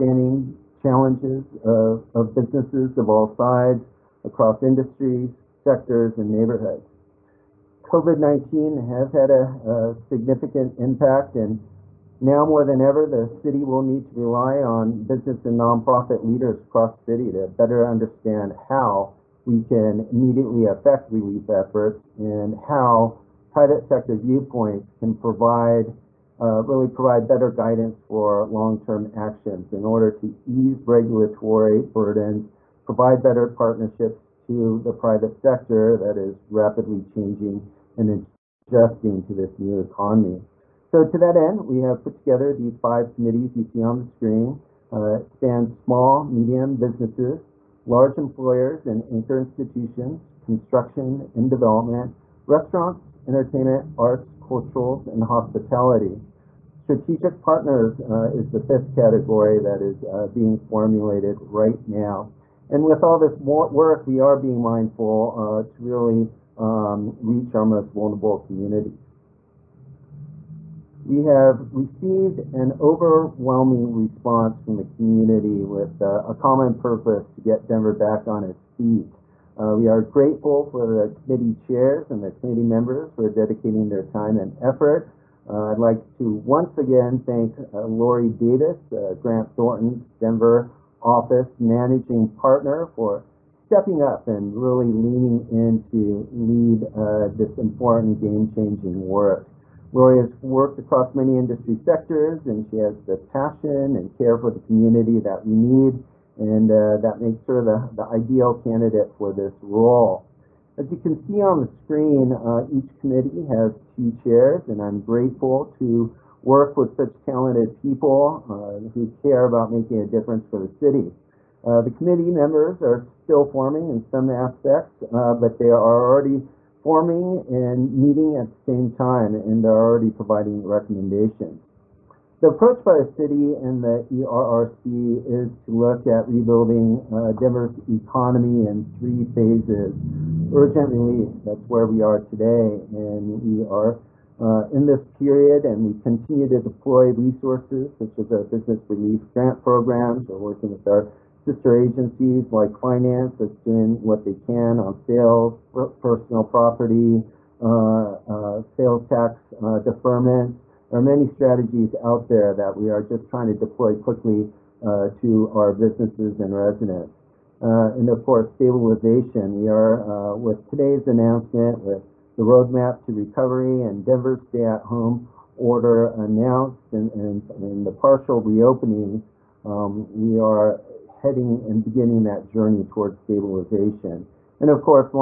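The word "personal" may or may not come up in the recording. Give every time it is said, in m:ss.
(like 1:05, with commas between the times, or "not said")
2:36.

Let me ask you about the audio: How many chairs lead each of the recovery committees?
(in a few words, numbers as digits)
2.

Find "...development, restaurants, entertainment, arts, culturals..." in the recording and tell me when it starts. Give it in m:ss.
0:51.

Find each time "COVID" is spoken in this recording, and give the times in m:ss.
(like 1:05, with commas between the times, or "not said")
0:07.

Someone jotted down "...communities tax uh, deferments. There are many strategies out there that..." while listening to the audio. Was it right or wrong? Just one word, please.
wrong.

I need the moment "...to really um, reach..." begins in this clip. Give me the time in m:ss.
1:05.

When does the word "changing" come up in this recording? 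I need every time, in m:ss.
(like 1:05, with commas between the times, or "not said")
0:37, 1:38.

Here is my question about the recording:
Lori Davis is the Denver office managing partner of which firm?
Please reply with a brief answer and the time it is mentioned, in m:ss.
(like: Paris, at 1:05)
Grant Thornton, at 1:29.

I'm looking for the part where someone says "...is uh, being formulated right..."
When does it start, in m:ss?
0:59.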